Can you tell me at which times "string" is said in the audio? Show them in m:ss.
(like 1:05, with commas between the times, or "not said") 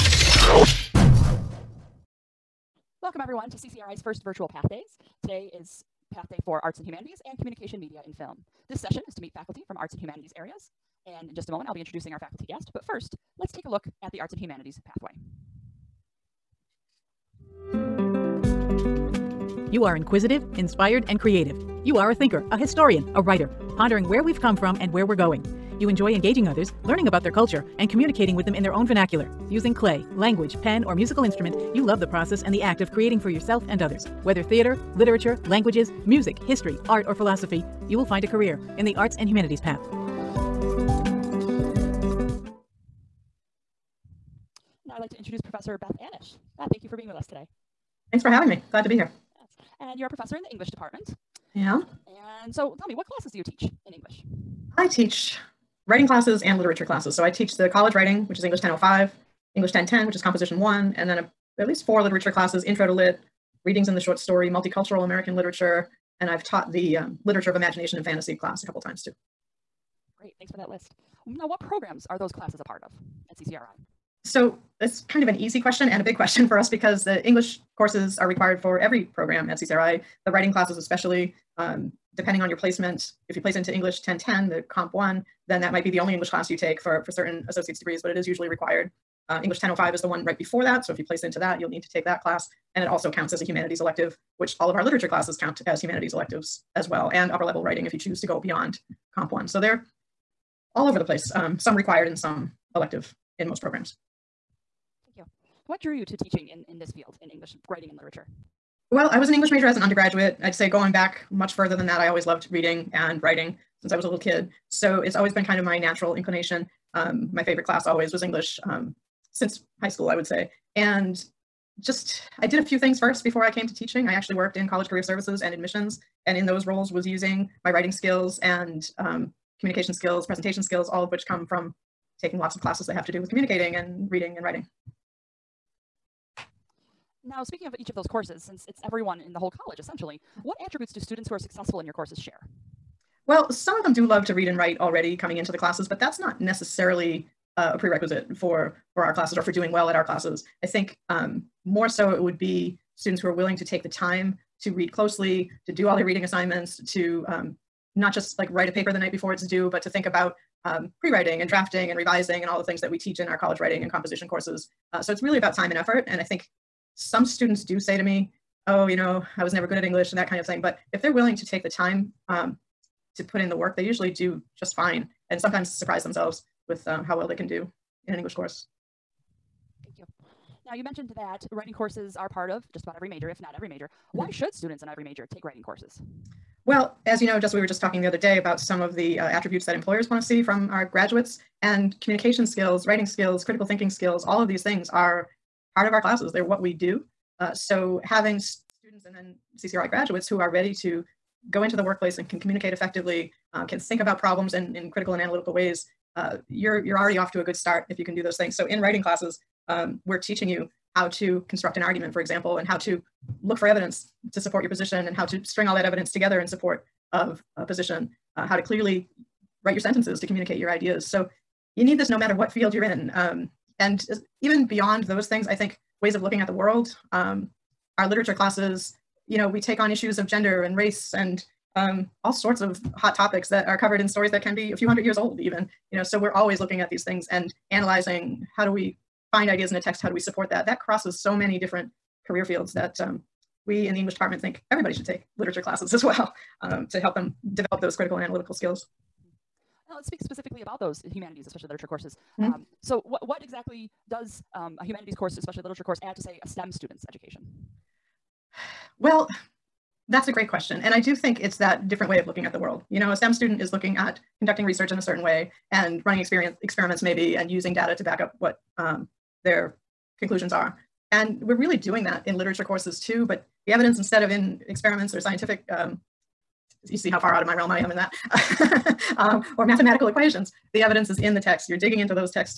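3:35.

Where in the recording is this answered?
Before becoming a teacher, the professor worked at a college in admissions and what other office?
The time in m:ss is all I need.
2:04.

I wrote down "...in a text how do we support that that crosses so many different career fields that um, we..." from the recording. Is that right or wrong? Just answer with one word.
right.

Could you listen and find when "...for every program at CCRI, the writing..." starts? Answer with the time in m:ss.
1:18.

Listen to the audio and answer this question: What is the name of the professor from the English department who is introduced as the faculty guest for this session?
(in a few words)
Beth Anish.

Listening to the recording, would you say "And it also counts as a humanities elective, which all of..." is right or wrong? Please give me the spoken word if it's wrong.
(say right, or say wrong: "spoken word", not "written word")
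right.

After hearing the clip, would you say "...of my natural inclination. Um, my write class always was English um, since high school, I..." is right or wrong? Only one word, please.
wrong.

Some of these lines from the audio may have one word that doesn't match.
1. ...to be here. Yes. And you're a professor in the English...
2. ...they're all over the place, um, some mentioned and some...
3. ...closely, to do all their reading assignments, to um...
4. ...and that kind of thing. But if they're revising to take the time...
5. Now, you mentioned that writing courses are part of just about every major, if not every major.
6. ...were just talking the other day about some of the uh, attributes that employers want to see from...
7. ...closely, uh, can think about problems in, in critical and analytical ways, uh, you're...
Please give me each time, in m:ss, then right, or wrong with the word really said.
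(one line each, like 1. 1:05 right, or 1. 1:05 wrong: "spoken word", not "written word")
1. 0:48 right
2. 1:39 wrong: "required", not "mentioned"
3. 2:34 right
4. 2:50 wrong: "willing", not "revising"
5. 3:00 right
6. 3:07 right
7. 3:22 wrong: "effectively", not "closely".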